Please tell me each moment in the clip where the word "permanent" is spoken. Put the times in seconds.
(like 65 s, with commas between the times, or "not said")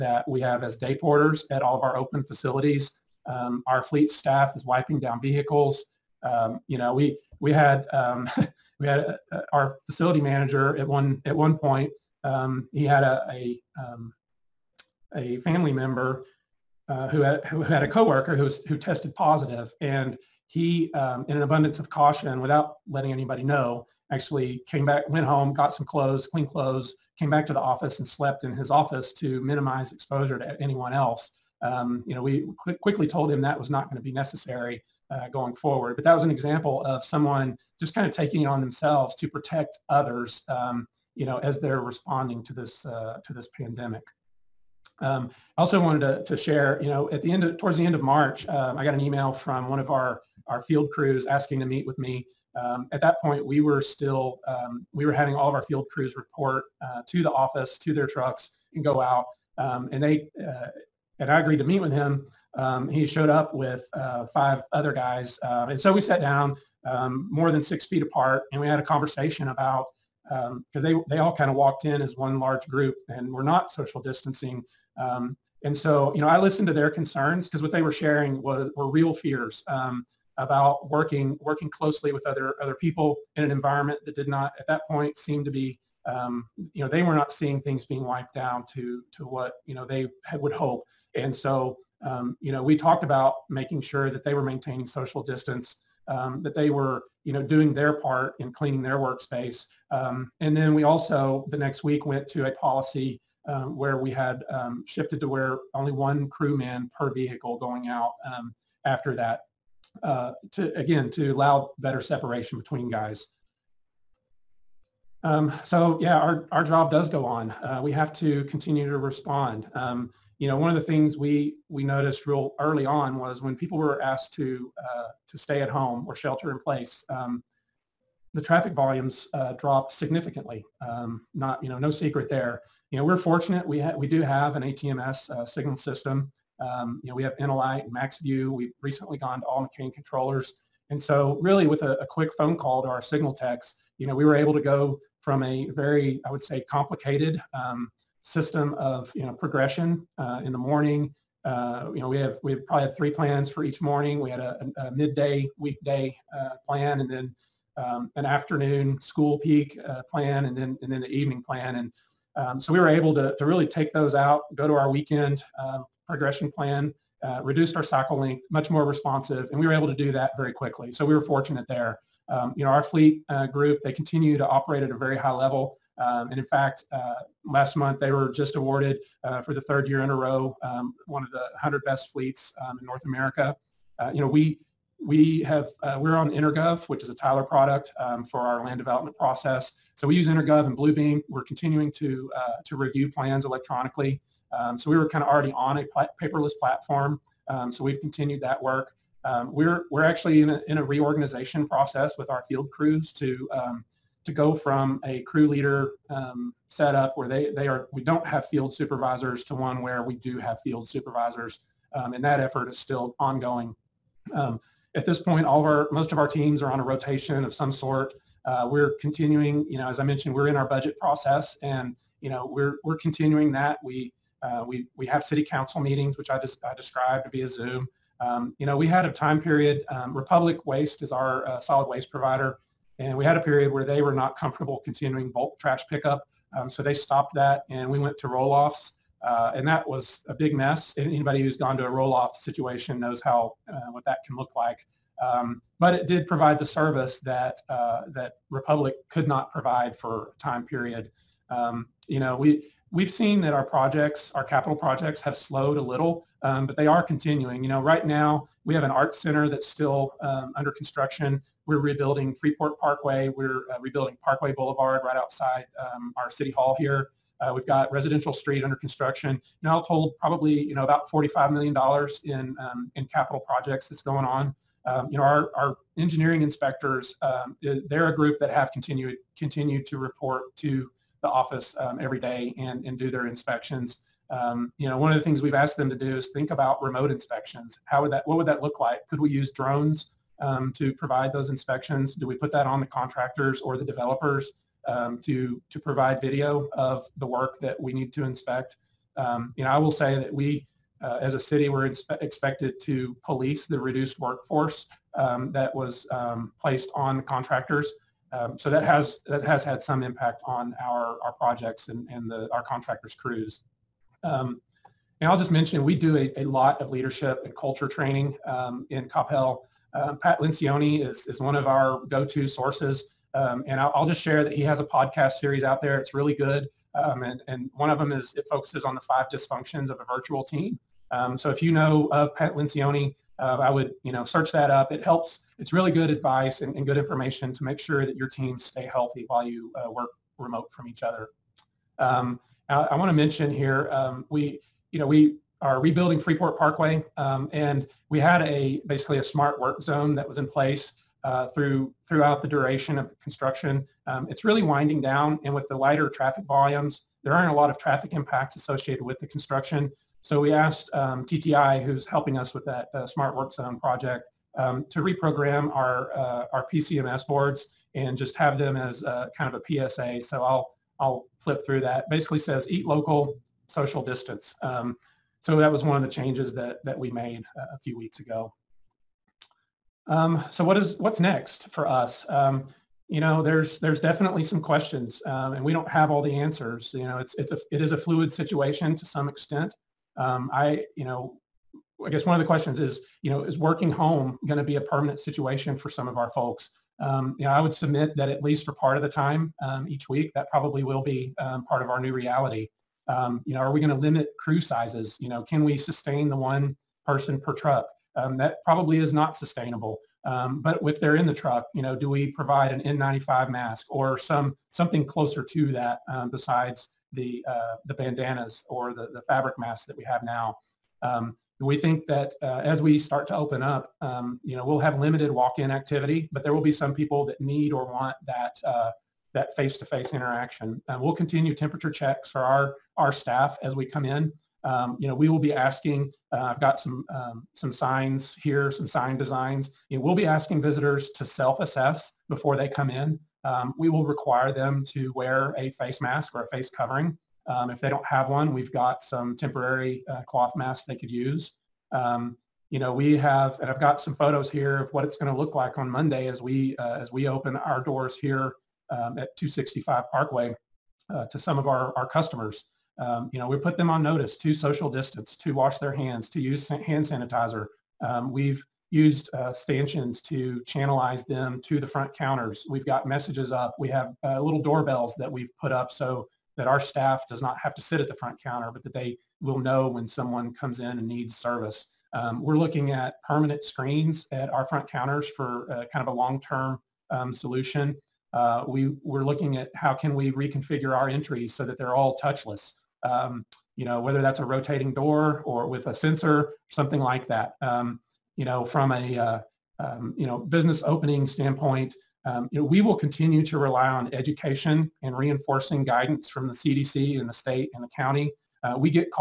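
394 s, 483 s.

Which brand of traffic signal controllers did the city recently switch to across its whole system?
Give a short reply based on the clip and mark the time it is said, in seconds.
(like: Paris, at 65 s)
McCain, at 139 s.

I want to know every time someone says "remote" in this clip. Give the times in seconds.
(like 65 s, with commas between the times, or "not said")
286 s, 340 s.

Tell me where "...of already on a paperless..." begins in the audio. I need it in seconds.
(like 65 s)
195 s.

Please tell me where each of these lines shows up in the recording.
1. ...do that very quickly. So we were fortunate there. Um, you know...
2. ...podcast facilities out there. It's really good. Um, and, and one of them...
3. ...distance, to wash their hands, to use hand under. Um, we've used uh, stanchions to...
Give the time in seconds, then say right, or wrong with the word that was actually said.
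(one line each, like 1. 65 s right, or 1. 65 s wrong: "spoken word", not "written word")
1. 169 s right
2. 324 s wrong: "series", not "facilities"
3. 464 s wrong: "sanitizer", not "under".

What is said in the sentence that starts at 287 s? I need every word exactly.
How would that, what would that look like?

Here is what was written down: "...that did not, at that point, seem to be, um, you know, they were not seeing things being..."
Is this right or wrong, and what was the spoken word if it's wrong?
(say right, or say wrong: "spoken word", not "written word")
right.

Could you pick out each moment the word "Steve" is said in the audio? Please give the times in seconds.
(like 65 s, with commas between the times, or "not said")
not said.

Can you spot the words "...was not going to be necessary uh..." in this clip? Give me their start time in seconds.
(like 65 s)
33 s.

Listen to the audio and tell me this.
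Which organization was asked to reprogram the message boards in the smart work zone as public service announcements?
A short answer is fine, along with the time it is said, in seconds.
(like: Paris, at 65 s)
TTI, at 361 s.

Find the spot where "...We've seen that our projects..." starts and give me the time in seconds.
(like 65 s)
252 s.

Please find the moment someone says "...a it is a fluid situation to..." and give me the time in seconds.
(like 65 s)
387 s.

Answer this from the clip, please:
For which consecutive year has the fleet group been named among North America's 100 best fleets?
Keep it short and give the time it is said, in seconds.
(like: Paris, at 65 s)
third, at 179 s.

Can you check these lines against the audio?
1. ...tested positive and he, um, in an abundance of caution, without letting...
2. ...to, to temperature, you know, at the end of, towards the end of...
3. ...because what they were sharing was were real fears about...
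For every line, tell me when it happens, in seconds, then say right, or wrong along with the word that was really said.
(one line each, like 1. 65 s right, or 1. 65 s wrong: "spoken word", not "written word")
1. 18 s right
2. 46 s wrong: "share", not "temperature"
3. 77 s right.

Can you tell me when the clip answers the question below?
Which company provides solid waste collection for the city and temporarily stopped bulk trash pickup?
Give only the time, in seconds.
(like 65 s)
230 s.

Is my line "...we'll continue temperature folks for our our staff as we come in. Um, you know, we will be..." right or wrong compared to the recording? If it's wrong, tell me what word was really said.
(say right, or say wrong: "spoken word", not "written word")
wrong: "checks", not "folks".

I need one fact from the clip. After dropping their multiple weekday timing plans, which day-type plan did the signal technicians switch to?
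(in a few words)
weekend.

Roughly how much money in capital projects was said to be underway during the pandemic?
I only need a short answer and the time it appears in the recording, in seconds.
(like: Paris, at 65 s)
$45 million, at 271 s.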